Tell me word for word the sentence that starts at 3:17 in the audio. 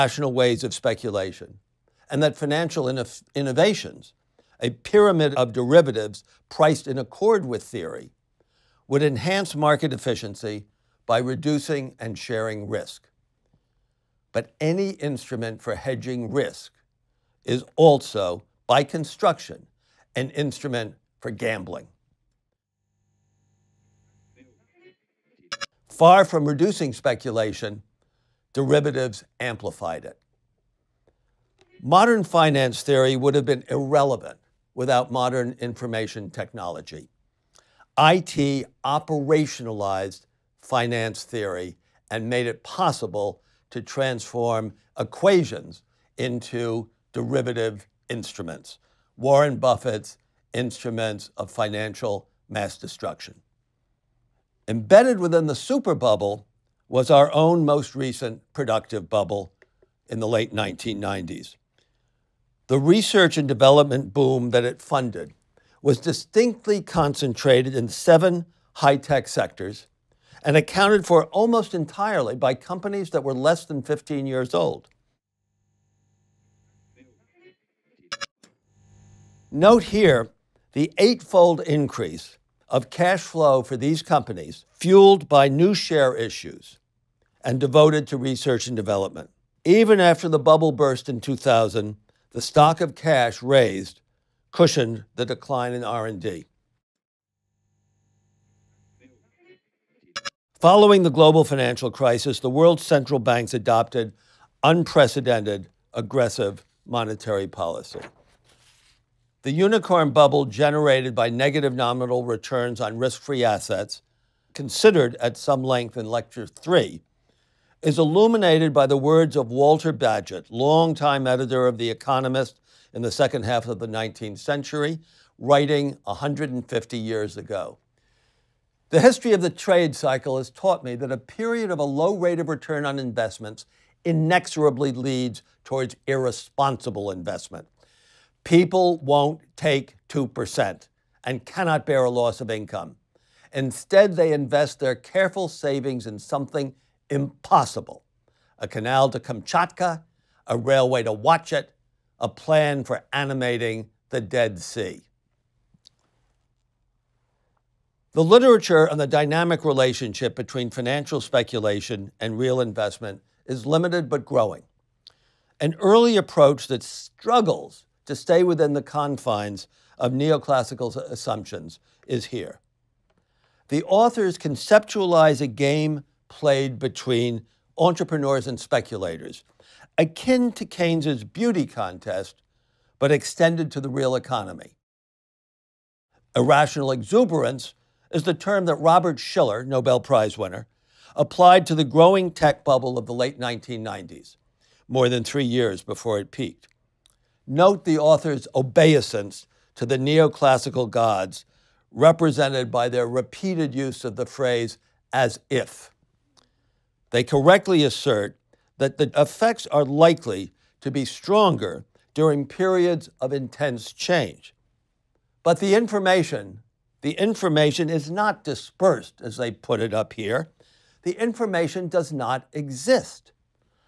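Note the author's obeisance to the neoclassical gods, represented by their repeated use of the phrase as if.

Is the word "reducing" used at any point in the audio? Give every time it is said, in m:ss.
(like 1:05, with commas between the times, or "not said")
0:11, 0:26.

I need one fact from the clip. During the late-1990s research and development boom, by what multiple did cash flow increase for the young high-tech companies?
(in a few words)
eightfold.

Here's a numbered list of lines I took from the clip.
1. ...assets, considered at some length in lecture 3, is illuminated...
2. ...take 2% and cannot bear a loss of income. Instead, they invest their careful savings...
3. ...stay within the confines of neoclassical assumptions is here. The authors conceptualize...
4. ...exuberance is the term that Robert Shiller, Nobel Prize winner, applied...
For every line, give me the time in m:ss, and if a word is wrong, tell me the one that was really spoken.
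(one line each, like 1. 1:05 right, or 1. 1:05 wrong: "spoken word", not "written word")
1. 1:53 right
2. 2:19 right
3. 2:48 right
4. 3:06 right.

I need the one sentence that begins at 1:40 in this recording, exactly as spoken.
Following the global financial crisis, the world's central banks adopted unprecedented aggressive monetary policy.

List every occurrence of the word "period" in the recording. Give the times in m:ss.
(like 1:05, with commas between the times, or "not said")
2:11, 3:32.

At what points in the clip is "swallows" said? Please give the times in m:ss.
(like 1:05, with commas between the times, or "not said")
not said.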